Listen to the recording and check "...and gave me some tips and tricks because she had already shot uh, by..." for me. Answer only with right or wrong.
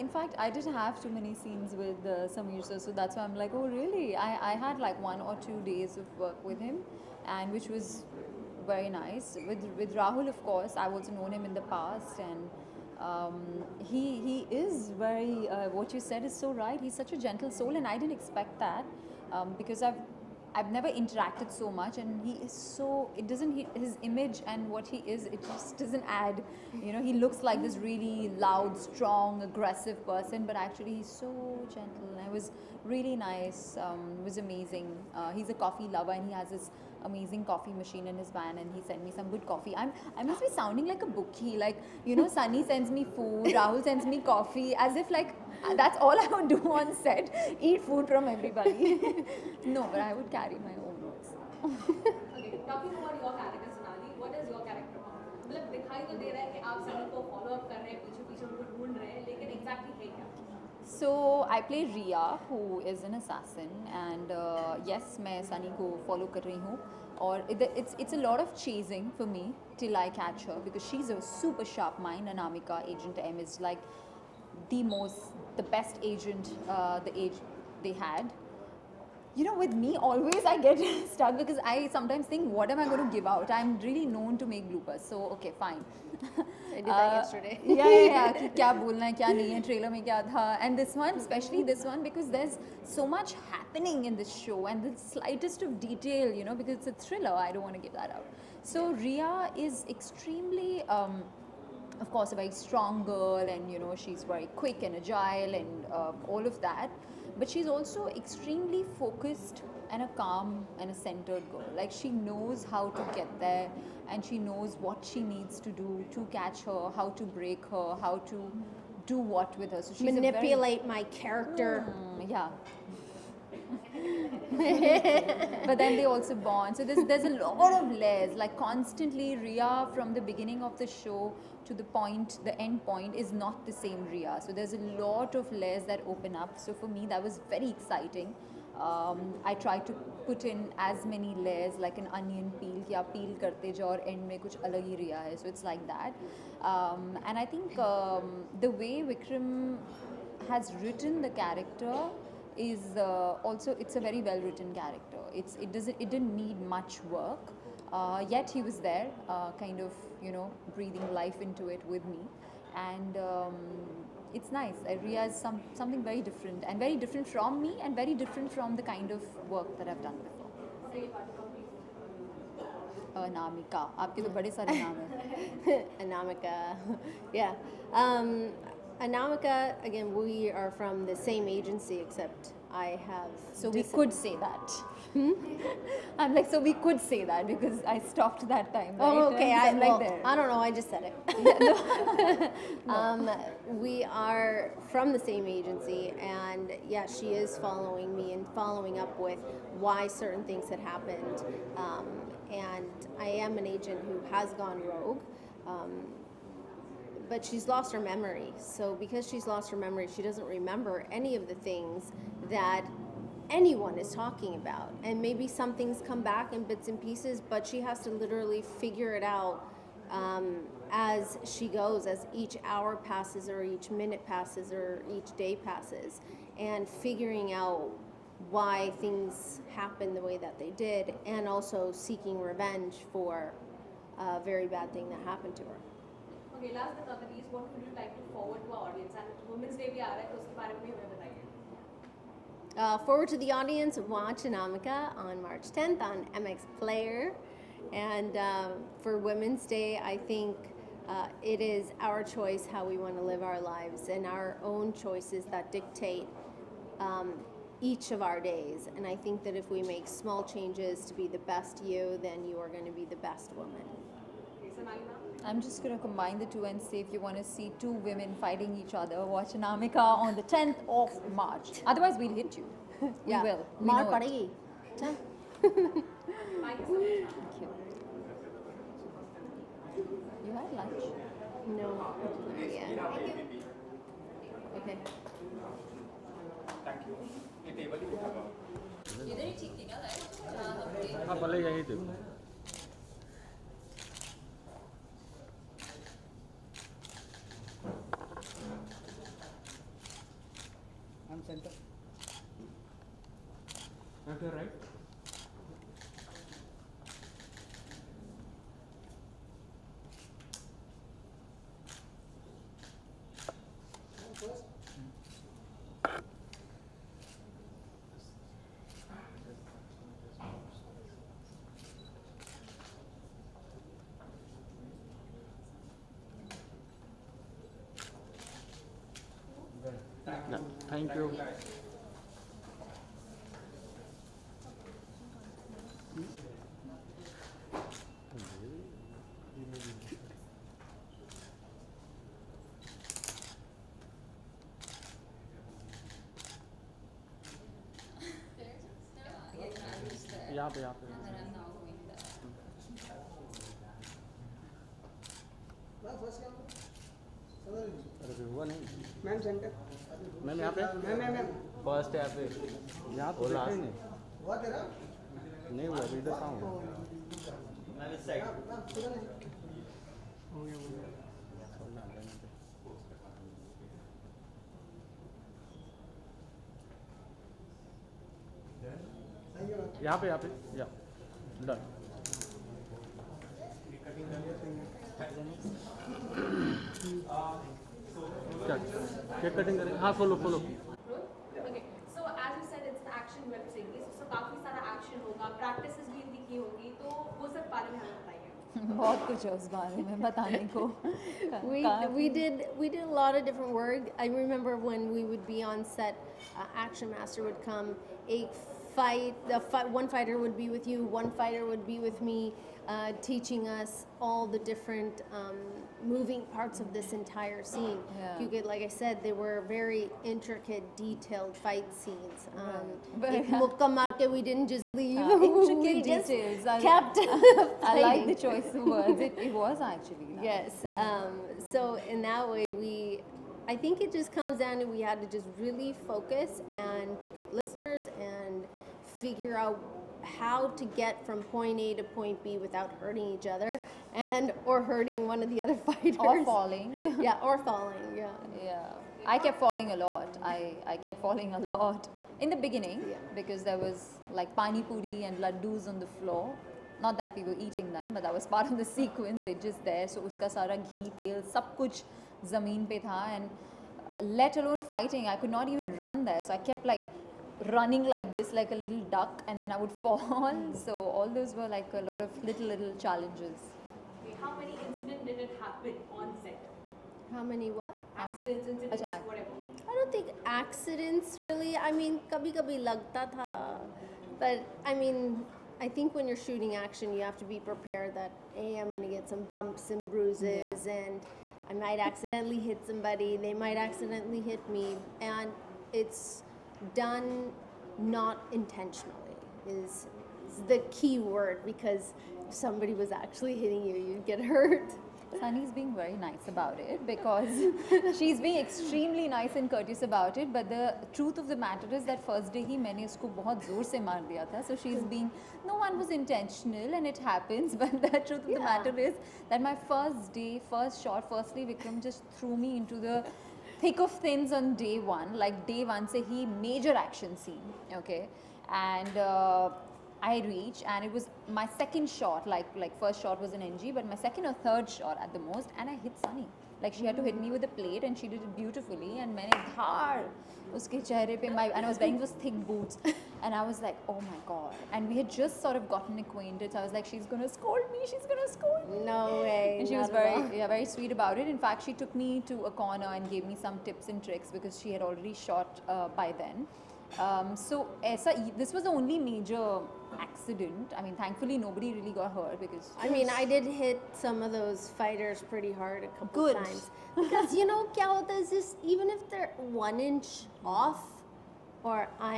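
right.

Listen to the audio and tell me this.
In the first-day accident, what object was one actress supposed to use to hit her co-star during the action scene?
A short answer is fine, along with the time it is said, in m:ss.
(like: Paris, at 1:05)
a plate, at 8:57.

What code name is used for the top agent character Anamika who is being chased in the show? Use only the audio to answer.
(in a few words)
Agent M.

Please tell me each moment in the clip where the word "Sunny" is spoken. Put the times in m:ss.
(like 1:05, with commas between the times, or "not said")
0:42, 1:05, 8:25, 8:56.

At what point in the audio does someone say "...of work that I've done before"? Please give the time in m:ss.
2:49.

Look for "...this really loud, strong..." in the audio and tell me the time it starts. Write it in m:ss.
0:27.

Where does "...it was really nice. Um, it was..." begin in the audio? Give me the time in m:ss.
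0:32.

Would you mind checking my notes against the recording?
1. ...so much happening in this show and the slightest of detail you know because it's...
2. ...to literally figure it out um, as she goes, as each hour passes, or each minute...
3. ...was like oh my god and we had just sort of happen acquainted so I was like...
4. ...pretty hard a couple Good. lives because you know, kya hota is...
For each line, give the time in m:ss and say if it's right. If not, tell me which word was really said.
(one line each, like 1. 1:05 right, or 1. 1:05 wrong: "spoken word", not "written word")
1. 1:32 right
2. 3:38 right
3. 9:03 wrong: "gotten", not "happen"
4. 9:25 wrong: "times", not "lives".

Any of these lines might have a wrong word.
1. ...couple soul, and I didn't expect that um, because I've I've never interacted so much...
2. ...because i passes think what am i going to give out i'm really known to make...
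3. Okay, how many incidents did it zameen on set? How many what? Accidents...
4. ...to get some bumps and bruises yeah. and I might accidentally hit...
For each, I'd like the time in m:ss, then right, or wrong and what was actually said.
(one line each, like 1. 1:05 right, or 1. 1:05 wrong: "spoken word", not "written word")
1. 0:17 wrong: "gentle", not "couple"
2. 1:21 wrong: "sometimes", not "passes"
3. 7:54 wrong: "happen", not "zameen"
4. 8:09 right.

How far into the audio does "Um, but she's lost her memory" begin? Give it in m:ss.
3:25.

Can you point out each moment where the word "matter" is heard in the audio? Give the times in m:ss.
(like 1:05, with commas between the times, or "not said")
8:31, 8:38.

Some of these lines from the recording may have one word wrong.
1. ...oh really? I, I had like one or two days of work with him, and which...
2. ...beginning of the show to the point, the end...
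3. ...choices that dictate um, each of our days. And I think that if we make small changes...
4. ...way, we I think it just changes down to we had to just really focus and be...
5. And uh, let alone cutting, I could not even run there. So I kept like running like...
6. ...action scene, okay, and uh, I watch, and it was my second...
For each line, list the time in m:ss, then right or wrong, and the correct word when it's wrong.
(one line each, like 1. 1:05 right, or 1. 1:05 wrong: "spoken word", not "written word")
1. 0:03 right
2. 2:10 right
3. 4:14 right
4. 7:12 wrong: "comes", not "changes"
5. 7:43 wrong: "fighting", not "cutting"
6. 8:46 wrong: "reach", not "watch".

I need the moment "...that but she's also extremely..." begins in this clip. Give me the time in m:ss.
1:46.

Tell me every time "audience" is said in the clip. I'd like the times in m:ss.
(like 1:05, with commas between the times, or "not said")
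3:58, 4:03.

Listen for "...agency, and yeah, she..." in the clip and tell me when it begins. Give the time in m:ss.
3:15.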